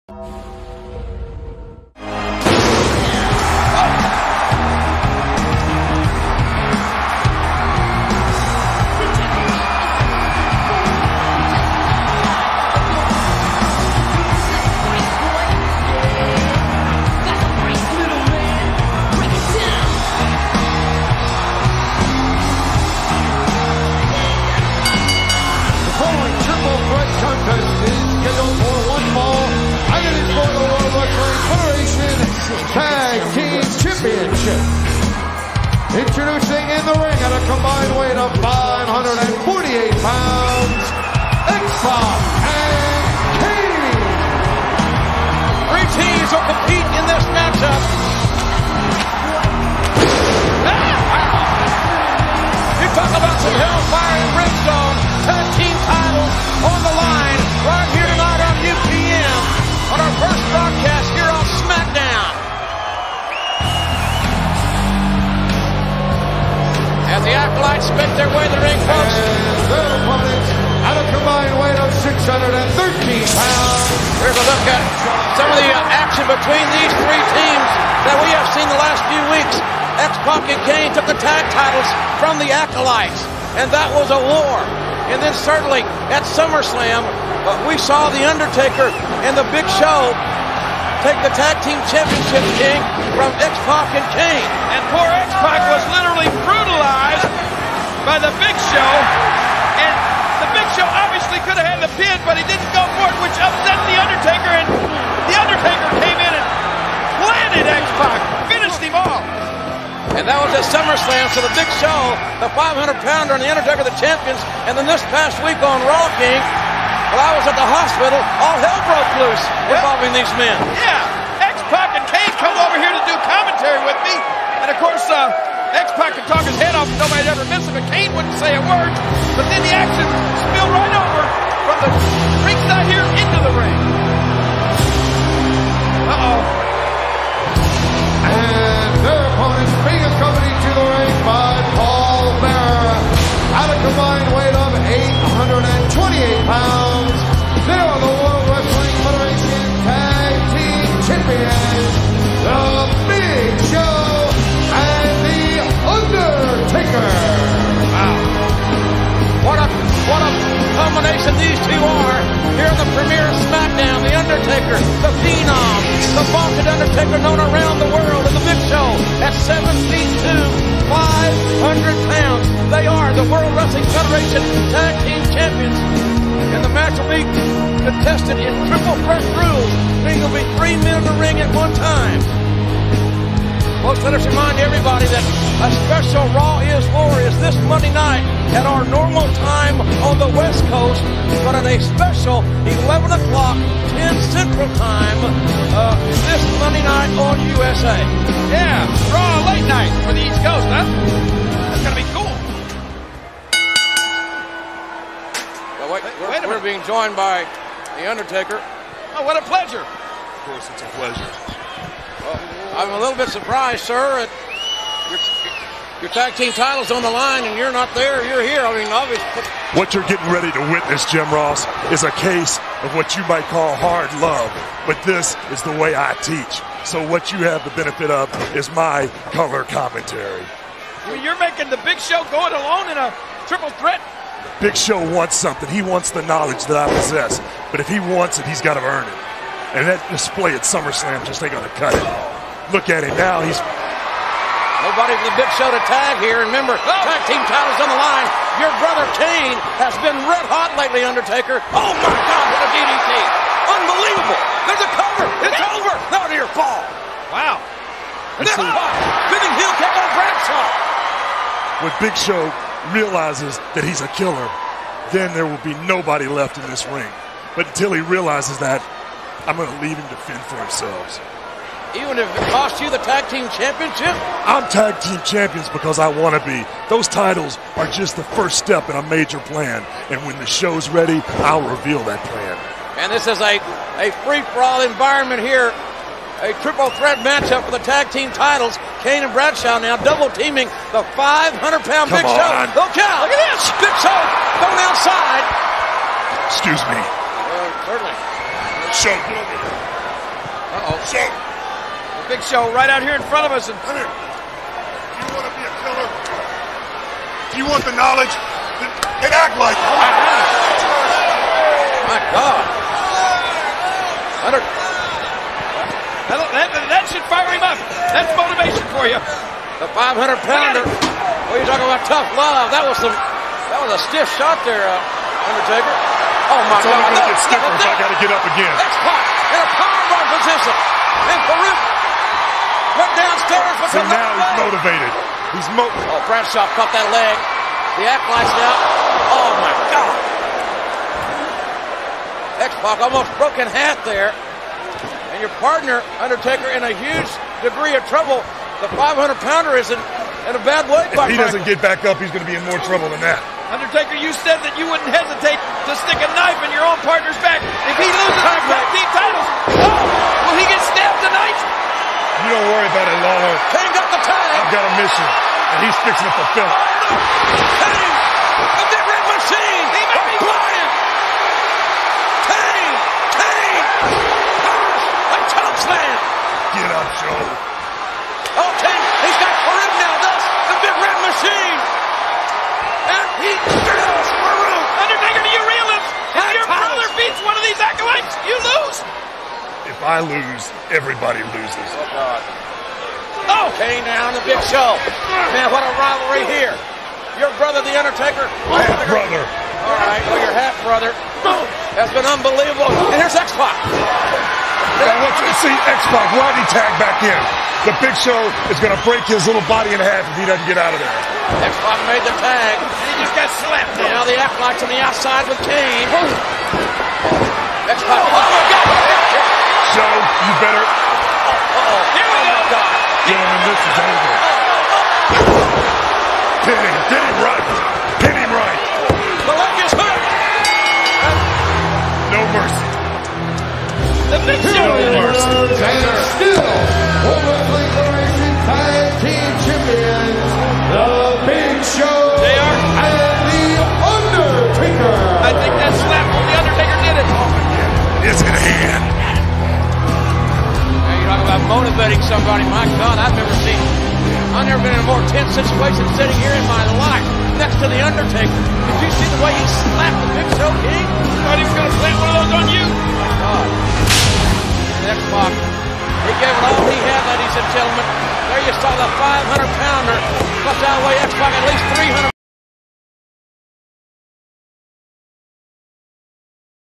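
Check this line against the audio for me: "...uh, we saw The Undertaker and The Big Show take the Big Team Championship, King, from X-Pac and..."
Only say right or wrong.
wrong.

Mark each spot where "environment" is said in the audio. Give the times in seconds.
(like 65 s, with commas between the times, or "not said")
284 s.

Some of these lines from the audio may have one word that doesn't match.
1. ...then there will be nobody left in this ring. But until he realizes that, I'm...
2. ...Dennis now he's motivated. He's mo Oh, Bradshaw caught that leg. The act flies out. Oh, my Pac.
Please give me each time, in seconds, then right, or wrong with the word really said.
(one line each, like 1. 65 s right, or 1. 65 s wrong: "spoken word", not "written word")
1. 265 s right
2. 333 s wrong: "God", not "Pac".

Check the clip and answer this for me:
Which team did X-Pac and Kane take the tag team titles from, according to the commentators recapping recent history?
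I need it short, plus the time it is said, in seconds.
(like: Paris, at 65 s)
The Acolytes, at 82 s.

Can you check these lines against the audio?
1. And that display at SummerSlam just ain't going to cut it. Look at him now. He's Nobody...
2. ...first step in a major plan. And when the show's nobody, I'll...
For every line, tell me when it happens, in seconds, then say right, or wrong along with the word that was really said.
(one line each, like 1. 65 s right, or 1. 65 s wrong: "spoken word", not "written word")
1. 239 s right
2. 278 s wrong: "ready", not "nobody".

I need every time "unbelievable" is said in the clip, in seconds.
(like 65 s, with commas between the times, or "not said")
253 s, 402 s.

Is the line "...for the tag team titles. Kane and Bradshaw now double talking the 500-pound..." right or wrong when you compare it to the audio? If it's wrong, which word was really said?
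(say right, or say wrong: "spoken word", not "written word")
wrong: "teaming", not "talking".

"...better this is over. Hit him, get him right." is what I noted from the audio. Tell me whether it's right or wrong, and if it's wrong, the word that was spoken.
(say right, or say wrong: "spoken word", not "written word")
right.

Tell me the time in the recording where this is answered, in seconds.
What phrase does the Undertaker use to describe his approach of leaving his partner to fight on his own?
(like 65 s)
223 s.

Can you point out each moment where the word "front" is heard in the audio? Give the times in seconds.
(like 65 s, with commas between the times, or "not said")
303 s.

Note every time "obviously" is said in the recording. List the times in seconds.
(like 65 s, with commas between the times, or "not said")
100 s, 218 s.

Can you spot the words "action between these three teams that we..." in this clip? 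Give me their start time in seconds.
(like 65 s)
76 s.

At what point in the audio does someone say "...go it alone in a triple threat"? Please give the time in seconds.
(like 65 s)
232 s.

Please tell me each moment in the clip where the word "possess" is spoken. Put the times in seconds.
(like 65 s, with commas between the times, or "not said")
236 s.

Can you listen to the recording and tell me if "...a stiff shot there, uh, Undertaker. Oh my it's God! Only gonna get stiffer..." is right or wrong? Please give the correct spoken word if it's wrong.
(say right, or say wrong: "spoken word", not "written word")
right.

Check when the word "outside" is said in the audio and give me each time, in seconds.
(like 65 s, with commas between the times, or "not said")
294 s, 415 s.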